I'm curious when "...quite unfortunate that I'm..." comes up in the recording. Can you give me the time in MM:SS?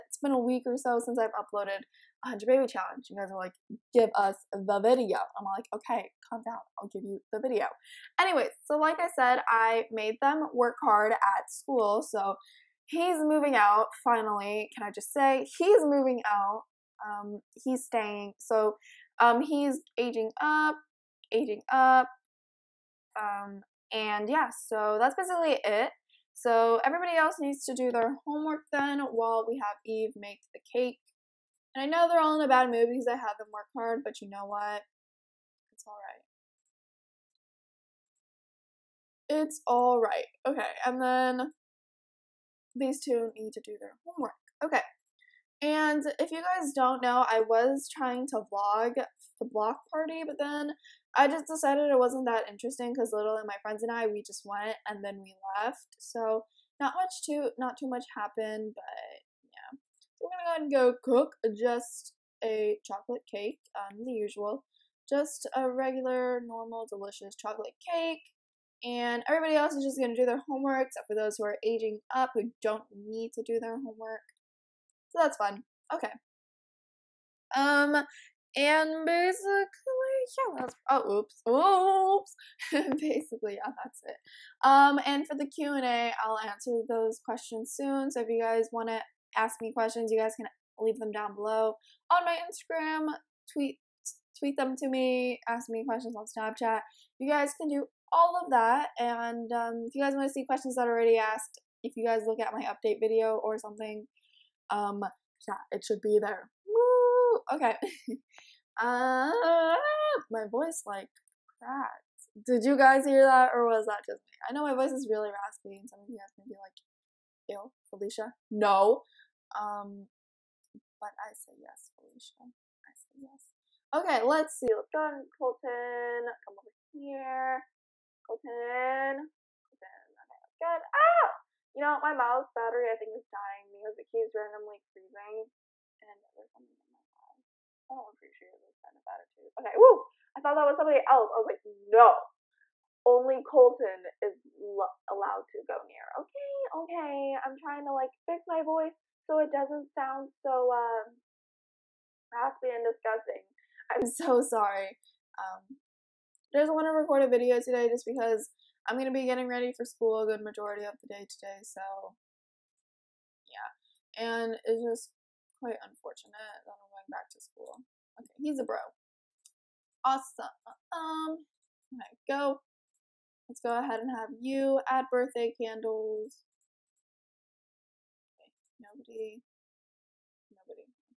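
02:45.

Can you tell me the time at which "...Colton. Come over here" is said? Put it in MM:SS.
02:05.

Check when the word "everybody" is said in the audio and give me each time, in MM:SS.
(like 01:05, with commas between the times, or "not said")
00:26, 01:09.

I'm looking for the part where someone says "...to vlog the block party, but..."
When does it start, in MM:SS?
00:48.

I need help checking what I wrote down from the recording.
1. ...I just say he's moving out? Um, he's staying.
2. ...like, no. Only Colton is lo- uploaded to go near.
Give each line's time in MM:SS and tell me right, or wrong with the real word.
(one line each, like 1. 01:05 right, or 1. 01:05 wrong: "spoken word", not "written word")
1. 00:14 right
2. 02:21 wrong: "allowed", not "uploaded".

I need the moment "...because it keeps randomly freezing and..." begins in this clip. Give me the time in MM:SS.
02:13.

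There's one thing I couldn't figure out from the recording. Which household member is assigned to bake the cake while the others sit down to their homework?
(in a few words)
Eve.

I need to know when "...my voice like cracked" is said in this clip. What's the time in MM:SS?
01:50.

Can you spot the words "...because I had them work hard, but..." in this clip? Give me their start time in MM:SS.
00:32.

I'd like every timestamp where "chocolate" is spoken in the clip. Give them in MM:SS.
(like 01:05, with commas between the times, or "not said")
01:02, 01:07.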